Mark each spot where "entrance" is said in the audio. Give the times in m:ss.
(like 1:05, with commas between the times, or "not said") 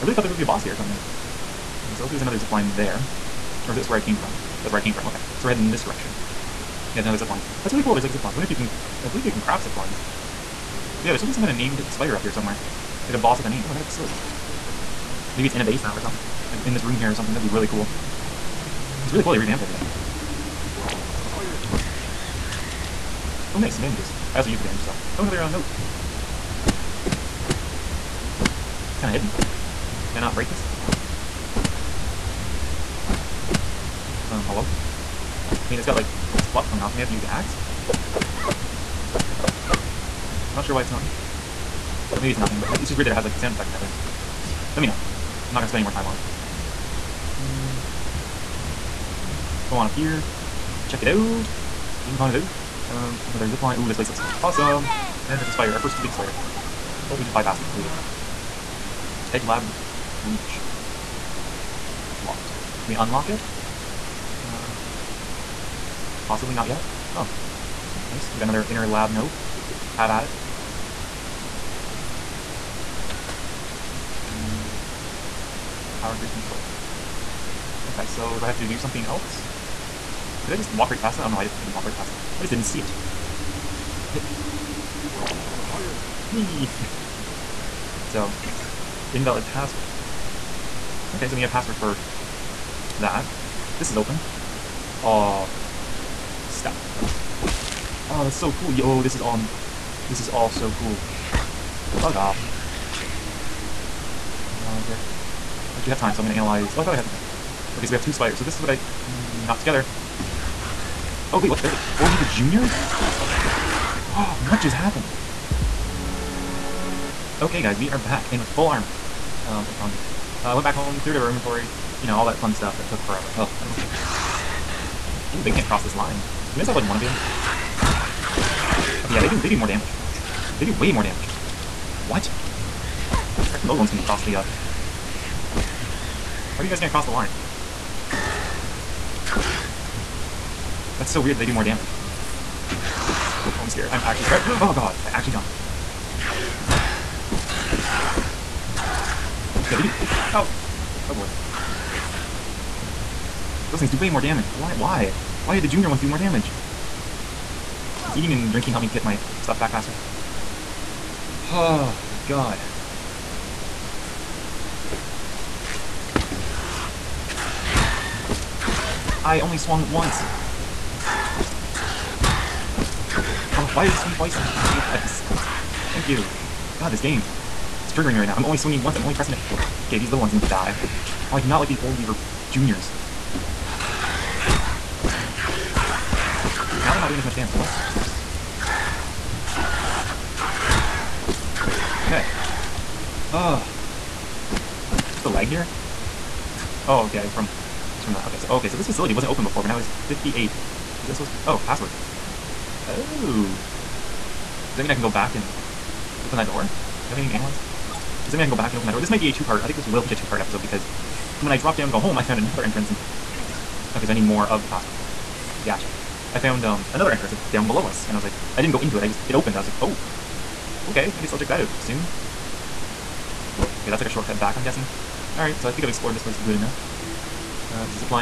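3:32, 3:37.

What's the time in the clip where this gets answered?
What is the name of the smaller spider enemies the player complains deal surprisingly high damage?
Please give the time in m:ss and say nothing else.
3:01.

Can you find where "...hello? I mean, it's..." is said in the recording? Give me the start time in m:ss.
0:34.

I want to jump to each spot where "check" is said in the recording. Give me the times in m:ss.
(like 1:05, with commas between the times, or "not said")
0:50, 3:41.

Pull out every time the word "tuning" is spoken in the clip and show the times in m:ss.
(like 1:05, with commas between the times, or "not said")
not said.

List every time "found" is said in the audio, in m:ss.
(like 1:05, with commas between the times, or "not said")
3:32, 3:36.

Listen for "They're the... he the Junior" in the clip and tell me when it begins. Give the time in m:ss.
1:51.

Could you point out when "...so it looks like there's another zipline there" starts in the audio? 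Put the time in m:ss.
0:01.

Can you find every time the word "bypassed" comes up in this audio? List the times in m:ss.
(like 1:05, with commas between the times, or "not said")
0:57.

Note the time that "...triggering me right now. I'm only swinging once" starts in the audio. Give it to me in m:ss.
2:57.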